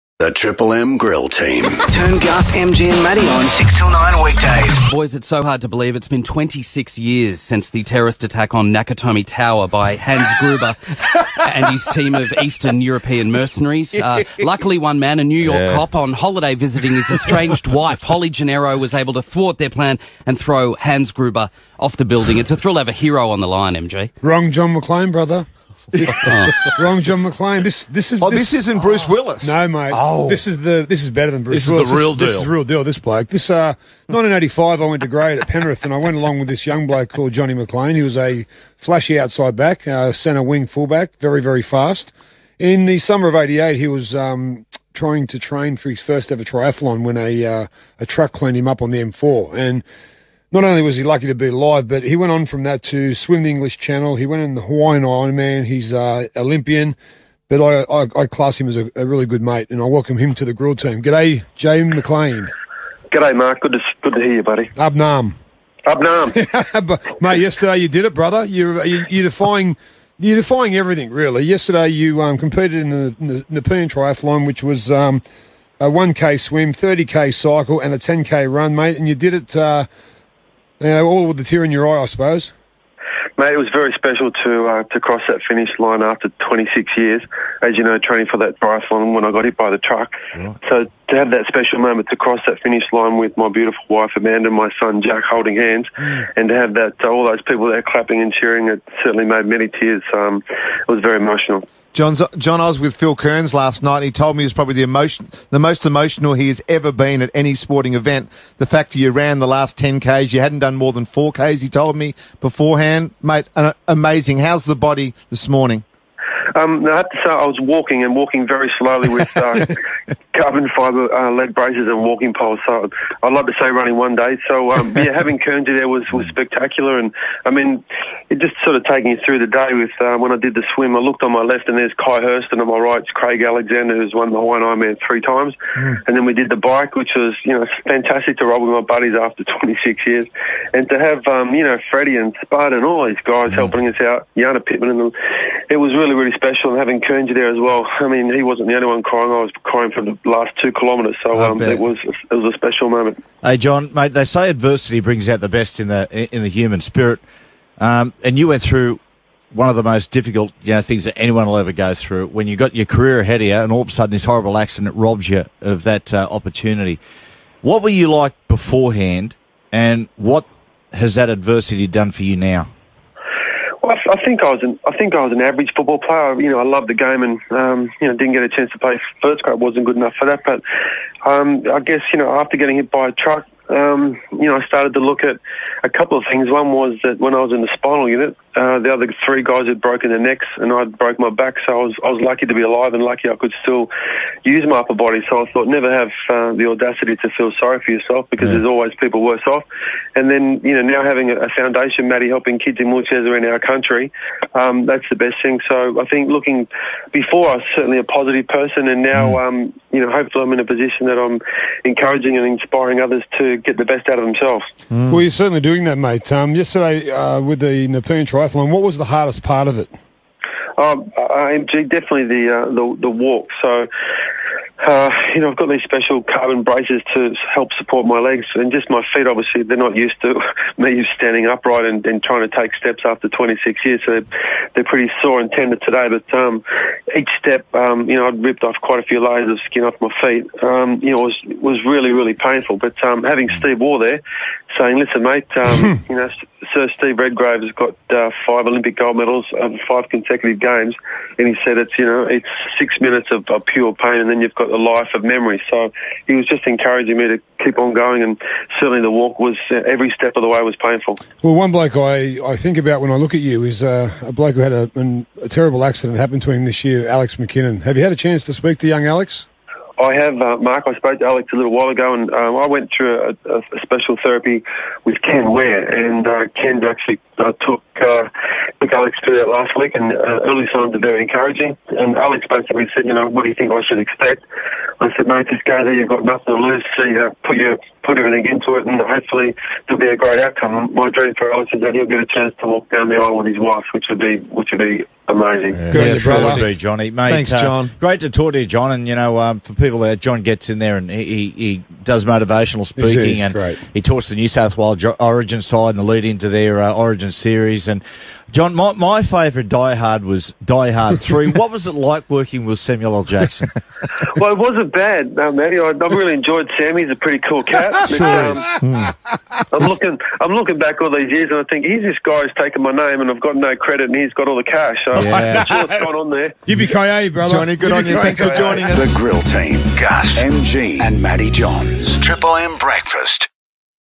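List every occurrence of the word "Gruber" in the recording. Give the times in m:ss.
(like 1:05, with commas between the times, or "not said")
0:10, 0:21.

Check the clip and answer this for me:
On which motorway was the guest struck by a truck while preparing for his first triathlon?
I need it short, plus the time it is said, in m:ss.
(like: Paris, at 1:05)
M4, at 0:49.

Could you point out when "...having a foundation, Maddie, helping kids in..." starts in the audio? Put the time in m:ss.
3:21.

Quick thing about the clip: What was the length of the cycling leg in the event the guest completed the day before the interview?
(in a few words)
30K.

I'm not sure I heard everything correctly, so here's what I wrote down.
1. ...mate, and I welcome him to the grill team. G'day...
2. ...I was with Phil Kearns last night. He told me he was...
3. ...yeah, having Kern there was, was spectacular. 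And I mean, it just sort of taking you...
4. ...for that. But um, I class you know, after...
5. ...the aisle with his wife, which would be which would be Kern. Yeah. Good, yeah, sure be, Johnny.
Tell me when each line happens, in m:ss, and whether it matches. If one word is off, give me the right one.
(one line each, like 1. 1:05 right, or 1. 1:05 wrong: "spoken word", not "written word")
1. 0:59 right
2. 1:42 right
3. 2:04 right
4. 3:00 wrong: "guess", not "class"
5. 4:53 wrong: "Amazing", not "Kern".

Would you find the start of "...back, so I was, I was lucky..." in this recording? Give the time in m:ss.
3:11.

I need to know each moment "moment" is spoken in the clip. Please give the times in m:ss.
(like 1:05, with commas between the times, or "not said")
1:31, 2:32.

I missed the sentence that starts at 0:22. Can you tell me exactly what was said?
It's a thrill of a hero on the line, MG.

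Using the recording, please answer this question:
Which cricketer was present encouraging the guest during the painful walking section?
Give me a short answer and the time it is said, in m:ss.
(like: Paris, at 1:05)
Steve Waugh, at 4:03.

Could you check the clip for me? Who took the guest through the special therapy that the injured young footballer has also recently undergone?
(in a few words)
Ken Ware.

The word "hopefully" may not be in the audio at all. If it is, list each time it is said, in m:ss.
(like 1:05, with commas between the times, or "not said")
3:30, 4:48.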